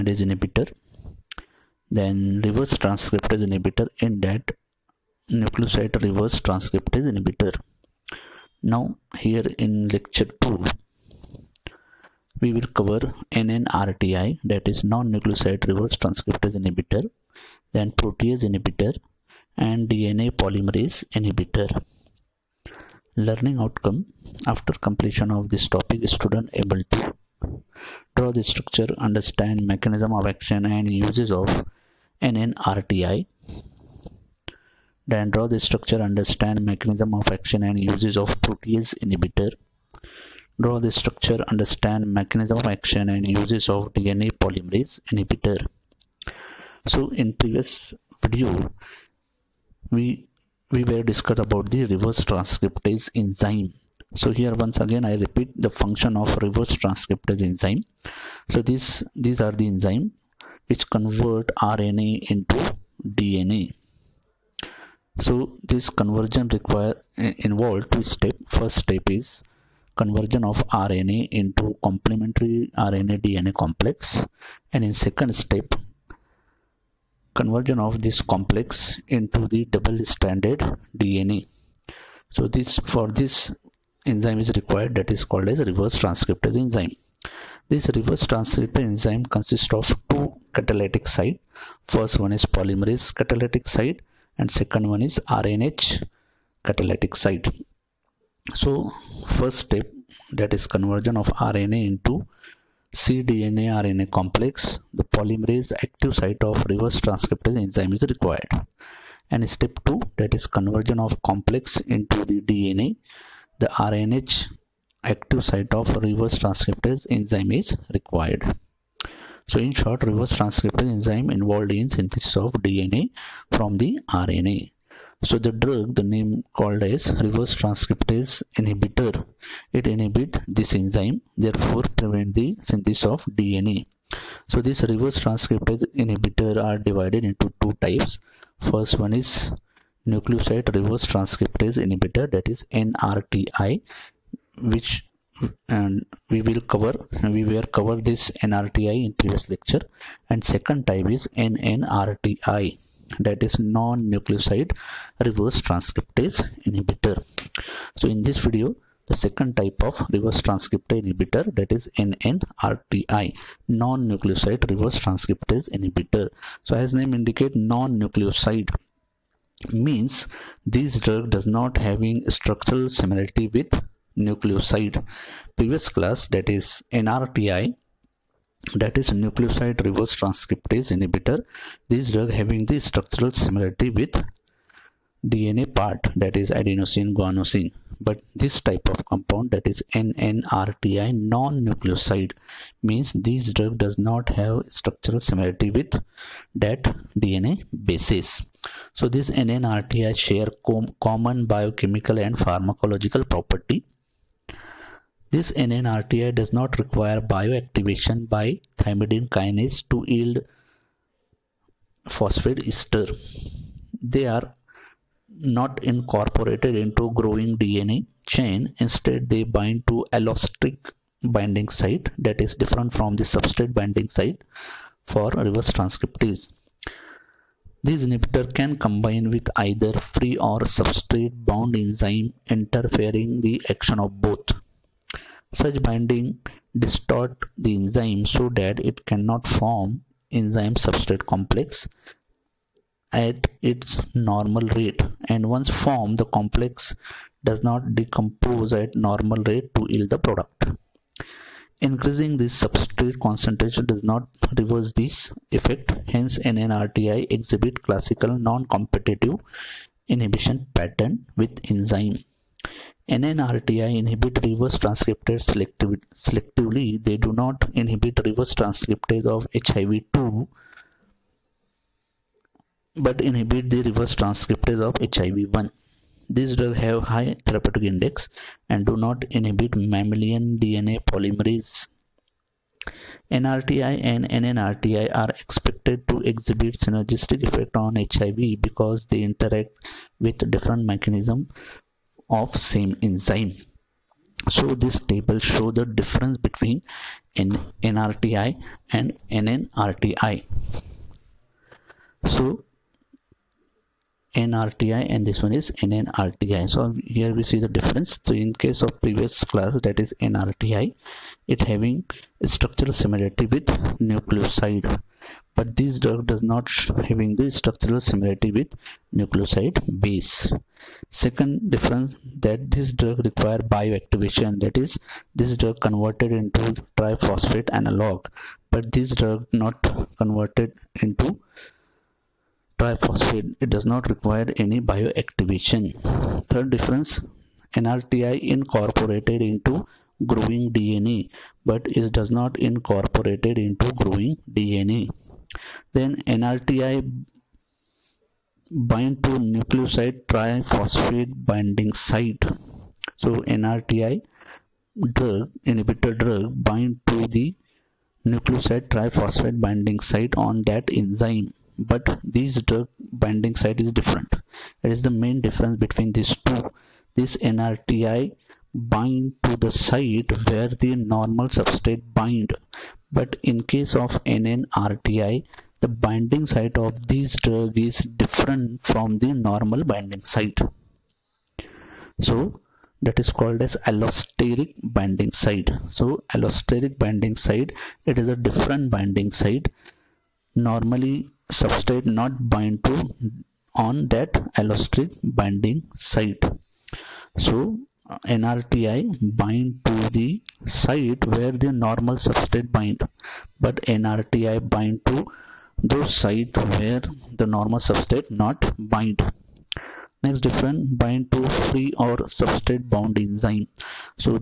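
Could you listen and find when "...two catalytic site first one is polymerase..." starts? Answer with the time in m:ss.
1:30.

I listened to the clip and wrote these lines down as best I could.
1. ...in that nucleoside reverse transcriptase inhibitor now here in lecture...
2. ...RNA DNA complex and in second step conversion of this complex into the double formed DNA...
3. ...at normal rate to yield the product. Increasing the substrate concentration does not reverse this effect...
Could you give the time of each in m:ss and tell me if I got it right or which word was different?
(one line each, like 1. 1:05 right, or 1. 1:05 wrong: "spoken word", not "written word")
1. 0:03 right
2. 1:12 wrong: "stranded", not "formed"
3. 4:08 right.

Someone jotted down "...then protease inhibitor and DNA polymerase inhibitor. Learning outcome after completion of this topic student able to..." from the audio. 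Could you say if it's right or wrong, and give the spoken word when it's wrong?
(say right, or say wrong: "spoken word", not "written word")
right.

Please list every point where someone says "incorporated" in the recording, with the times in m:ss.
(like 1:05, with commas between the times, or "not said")
3:35, 5:38, 5:42.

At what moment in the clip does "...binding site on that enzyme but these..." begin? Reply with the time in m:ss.
5:59.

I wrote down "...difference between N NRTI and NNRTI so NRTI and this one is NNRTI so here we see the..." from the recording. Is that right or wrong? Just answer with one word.
right.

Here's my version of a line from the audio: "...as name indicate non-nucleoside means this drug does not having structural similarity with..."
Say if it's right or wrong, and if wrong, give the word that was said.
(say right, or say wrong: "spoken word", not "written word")
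right.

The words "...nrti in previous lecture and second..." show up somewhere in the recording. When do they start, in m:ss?
2:28.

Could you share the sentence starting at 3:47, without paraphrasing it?
This inhibitor can combine with either free or substrate bound enzyme interfering the action of both.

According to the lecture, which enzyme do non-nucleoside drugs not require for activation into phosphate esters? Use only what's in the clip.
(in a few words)
Thymidine kinase.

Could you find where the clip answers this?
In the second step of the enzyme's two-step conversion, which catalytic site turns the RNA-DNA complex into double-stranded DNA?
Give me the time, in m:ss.
1:53.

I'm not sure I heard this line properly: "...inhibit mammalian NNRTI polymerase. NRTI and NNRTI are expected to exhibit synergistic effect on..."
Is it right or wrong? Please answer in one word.
wrong.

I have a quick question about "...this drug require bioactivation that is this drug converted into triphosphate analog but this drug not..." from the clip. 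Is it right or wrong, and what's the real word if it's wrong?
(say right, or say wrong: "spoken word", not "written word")
right.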